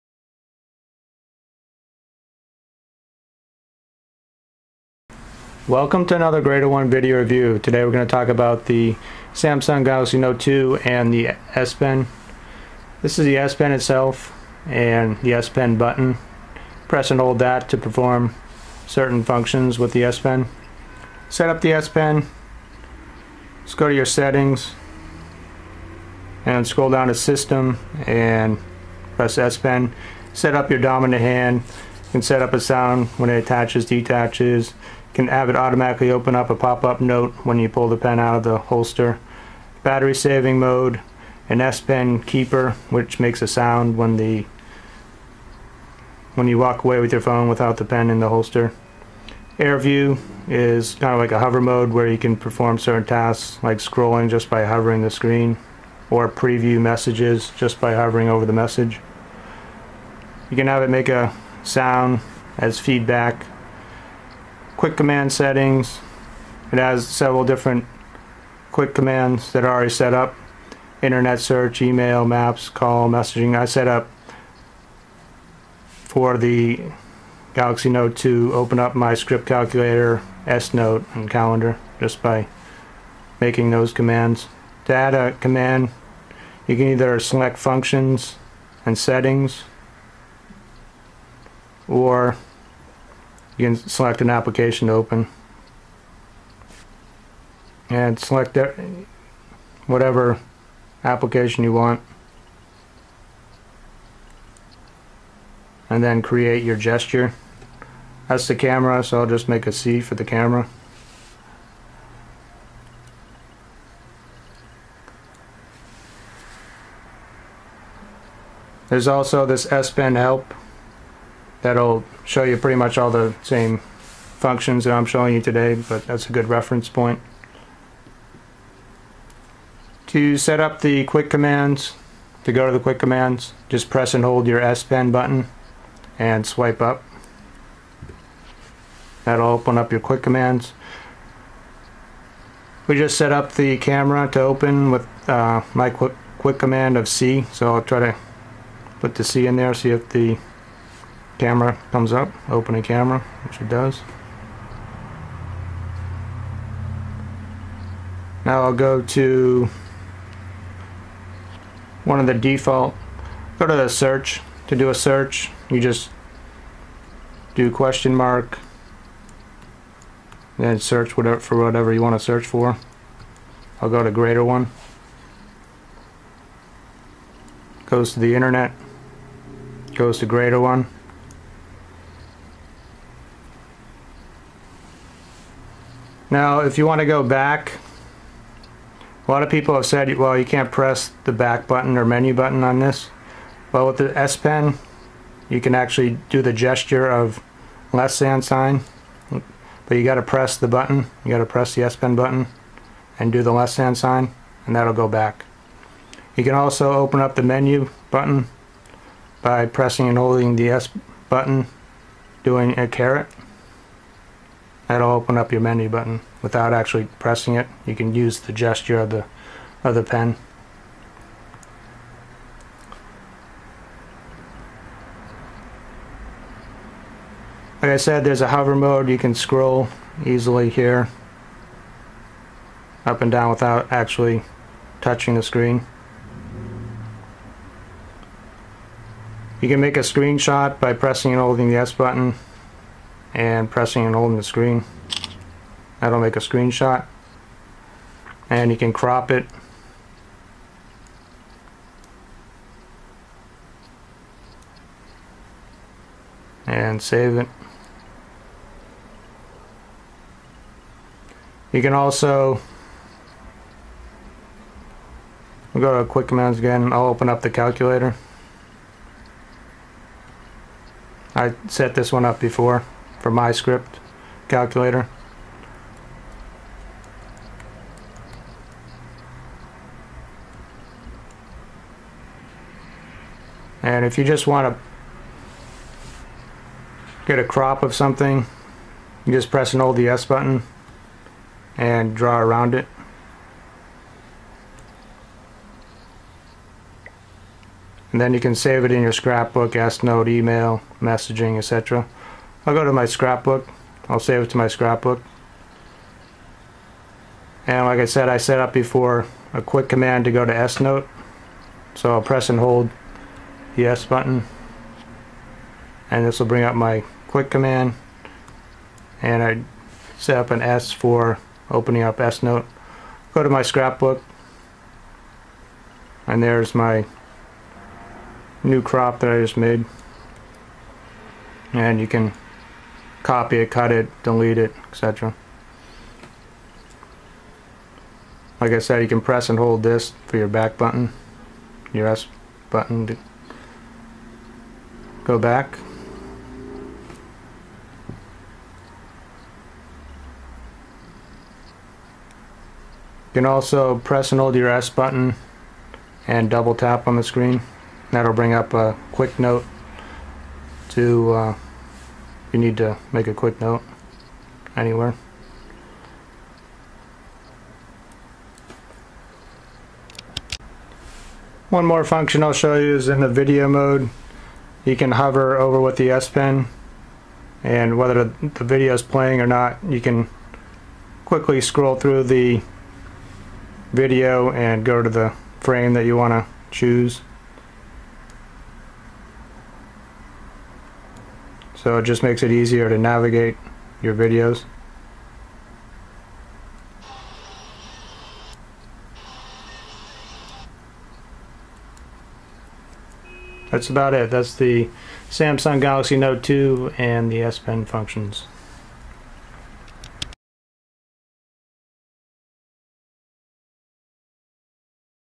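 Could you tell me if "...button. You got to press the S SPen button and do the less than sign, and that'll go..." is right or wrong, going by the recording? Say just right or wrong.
wrong.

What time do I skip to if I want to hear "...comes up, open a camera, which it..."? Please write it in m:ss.
2:31.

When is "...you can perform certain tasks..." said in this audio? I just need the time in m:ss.
0:52.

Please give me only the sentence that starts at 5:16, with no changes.
And this will bring up my quick command.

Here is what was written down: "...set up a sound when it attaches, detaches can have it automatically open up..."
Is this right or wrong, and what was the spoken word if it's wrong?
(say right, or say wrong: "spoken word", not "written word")
right.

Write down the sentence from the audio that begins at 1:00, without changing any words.
You can have it make a sound as feedback quick command settings.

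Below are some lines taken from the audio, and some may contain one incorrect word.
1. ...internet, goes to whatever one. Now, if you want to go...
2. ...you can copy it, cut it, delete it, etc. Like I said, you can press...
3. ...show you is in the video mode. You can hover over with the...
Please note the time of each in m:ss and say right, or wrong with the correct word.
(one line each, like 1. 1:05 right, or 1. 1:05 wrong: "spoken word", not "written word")
1. 2:58 wrong: "greater", not "whatever"
2. 5:31 right
3. 6:12 right.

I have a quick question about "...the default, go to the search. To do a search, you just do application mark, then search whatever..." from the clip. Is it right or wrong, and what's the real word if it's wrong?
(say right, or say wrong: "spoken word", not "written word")
wrong: "question", not "application".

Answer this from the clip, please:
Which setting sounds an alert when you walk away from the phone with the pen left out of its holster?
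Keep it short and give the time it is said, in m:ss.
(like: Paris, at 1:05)
S-Pen keeper, at 0:41.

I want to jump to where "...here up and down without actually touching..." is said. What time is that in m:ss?
3:50.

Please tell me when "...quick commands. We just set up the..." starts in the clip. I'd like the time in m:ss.
2:20.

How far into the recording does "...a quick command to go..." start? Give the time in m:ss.
5:09.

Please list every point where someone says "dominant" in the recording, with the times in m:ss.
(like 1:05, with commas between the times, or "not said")
0:30.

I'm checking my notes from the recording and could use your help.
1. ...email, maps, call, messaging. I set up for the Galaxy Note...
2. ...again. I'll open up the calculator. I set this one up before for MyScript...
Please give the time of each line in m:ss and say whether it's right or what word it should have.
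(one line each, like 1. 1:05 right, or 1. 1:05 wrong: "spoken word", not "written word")
1. 1:11 right
2. 4:26 right.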